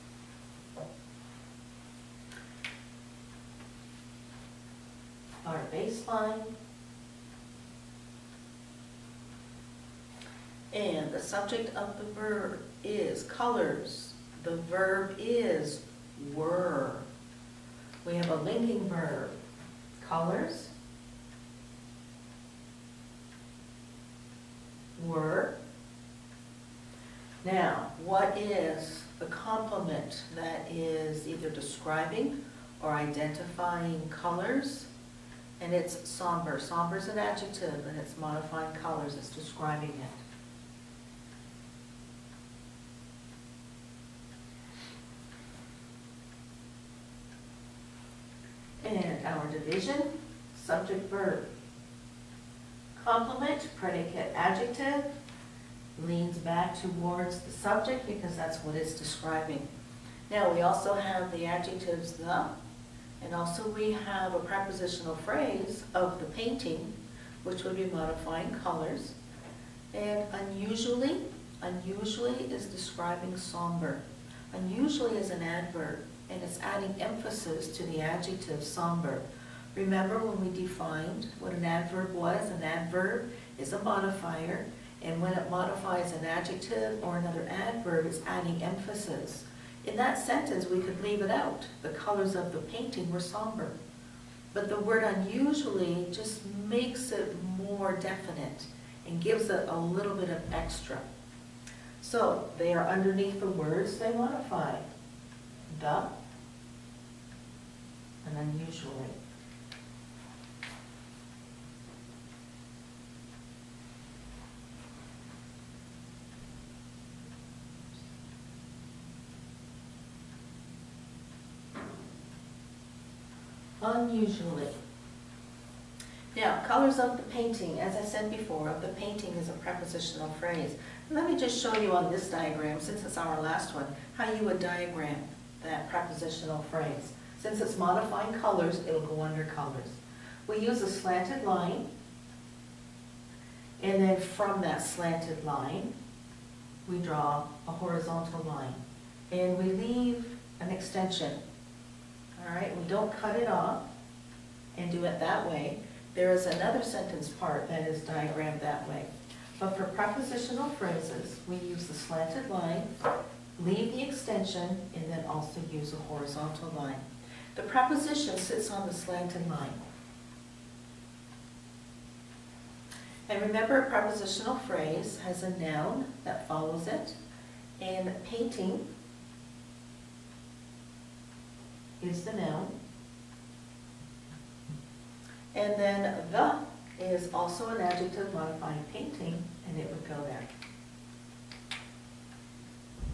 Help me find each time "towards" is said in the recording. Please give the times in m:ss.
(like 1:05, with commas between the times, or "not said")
0:56.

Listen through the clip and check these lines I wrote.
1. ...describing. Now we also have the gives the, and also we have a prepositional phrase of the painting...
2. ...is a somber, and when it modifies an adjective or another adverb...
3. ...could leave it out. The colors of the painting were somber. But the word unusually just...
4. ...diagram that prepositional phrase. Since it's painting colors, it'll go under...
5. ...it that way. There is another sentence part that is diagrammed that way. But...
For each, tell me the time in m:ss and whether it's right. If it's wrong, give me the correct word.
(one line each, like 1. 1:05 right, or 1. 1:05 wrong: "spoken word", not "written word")
1. 0:58 wrong: "adjectives", not "gives"
2. 1:23 wrong: "modifier", not "somber"
3. 1:30 right
4. 2:14 wrong: "modifying", not "painting"
5. 2:35 right.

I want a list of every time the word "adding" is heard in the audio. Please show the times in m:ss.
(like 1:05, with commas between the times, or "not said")
1:16, 1:28.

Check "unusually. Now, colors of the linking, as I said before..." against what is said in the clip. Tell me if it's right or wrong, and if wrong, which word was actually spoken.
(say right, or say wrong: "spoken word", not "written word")
wrong: "painting", not "linking".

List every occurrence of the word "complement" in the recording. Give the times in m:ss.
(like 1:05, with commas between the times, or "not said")
0:29, 0:53.